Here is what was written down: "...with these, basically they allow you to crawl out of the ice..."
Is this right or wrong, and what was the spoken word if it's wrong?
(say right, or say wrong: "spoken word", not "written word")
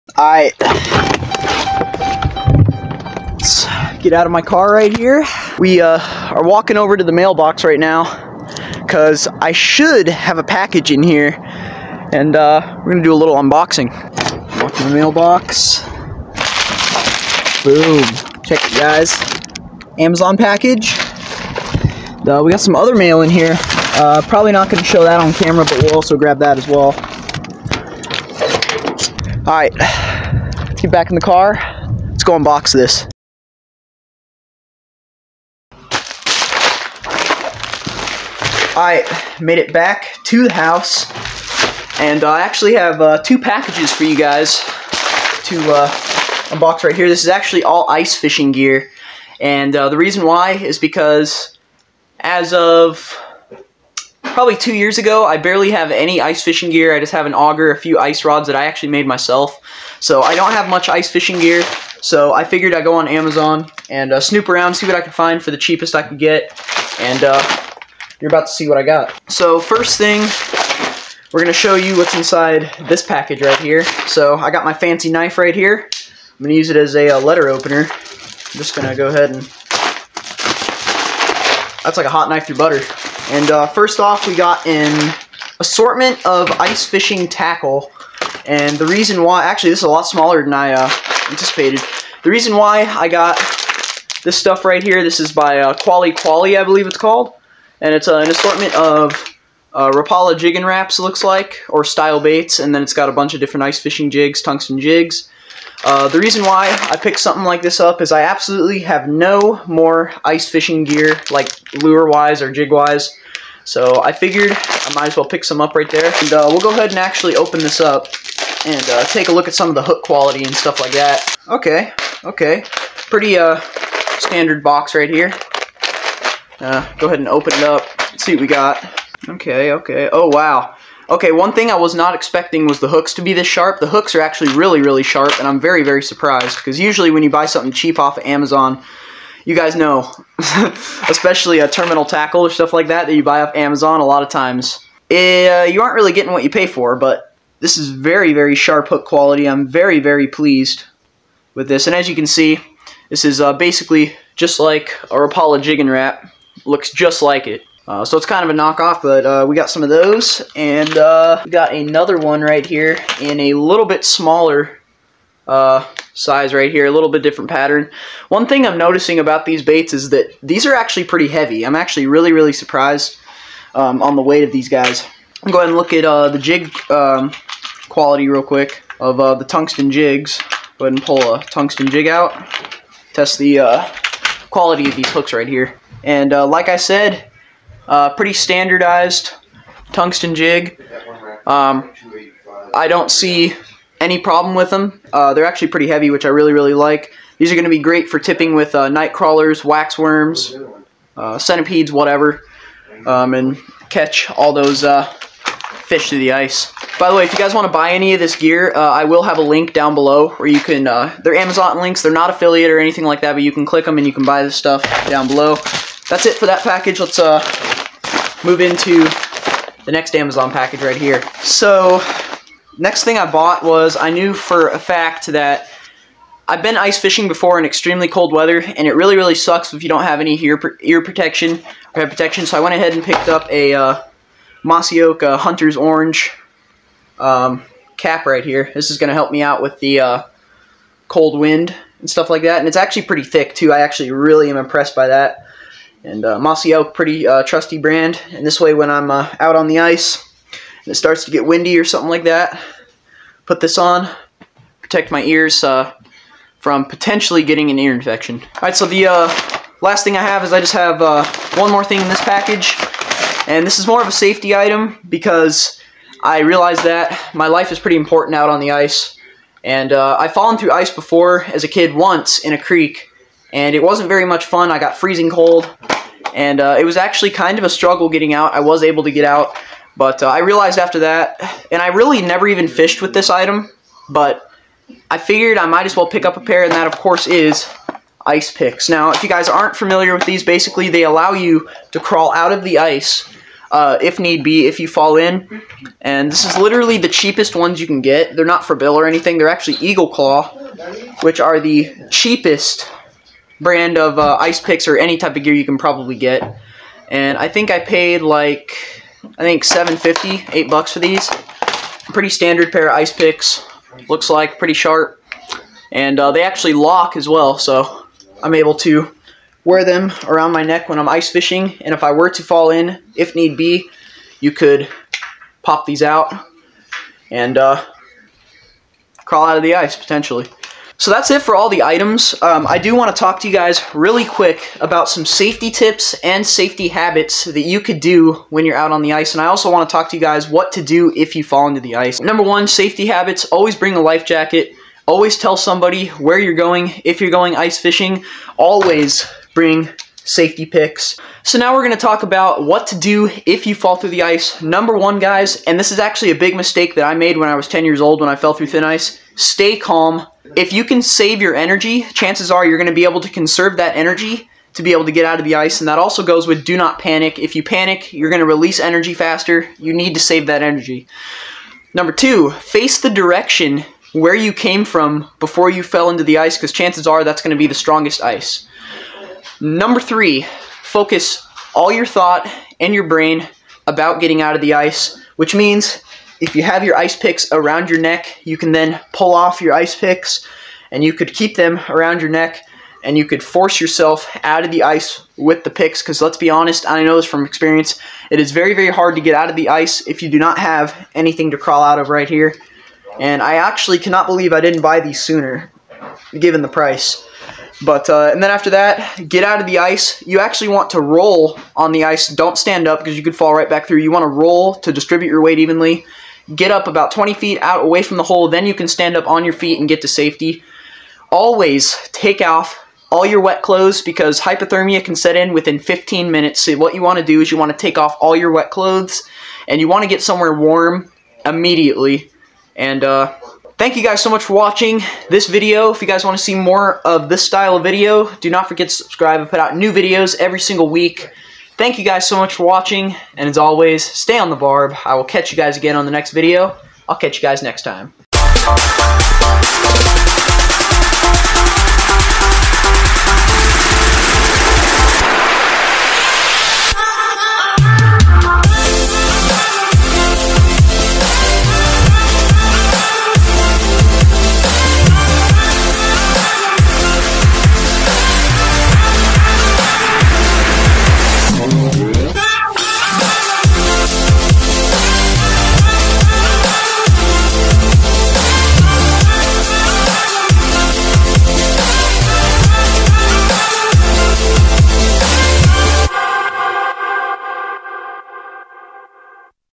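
right.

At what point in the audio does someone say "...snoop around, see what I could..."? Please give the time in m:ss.
1:04.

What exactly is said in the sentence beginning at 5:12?
Pretty standard pair of ice picks.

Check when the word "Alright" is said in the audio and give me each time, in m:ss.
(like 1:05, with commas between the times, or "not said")
0:00, 0:29.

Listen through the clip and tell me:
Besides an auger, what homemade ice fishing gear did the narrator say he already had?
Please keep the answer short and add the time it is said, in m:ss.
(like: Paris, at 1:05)
ice rods, at 0:57.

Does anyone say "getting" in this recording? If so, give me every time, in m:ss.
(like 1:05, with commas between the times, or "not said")
2:26, 4:17, 4:38, 6:24.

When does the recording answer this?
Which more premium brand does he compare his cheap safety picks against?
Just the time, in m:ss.
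4:58.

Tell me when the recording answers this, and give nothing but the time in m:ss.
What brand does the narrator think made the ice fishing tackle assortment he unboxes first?
1:35.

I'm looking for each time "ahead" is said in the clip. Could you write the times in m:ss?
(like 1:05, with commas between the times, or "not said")
1:19, 1:56, 2:07, 2:55, 3:00, 3:52.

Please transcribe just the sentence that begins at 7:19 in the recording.
I put out new videos every single week.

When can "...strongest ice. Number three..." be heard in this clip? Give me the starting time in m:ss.
6:17.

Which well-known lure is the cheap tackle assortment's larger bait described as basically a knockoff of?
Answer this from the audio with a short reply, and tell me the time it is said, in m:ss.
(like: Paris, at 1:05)
Rapala jigging Rap, at 2:35.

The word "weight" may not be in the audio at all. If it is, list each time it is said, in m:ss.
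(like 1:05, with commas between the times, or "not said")
2:54, 6:55.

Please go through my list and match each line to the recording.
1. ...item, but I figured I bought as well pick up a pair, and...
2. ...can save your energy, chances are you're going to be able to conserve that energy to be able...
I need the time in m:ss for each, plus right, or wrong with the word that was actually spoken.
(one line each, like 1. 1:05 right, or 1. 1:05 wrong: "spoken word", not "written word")
1. 4:43 wrong: "might", not "bought"
2. 6:00 right.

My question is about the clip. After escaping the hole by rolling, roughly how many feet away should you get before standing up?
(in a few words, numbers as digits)
20 feet.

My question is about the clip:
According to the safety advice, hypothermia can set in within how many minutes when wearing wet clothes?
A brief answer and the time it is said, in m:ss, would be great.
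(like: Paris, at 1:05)
15 minutes, at 7:05.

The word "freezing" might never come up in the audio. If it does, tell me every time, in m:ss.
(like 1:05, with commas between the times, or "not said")
4:34.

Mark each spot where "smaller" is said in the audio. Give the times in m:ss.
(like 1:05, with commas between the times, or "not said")
1:30, 2:44.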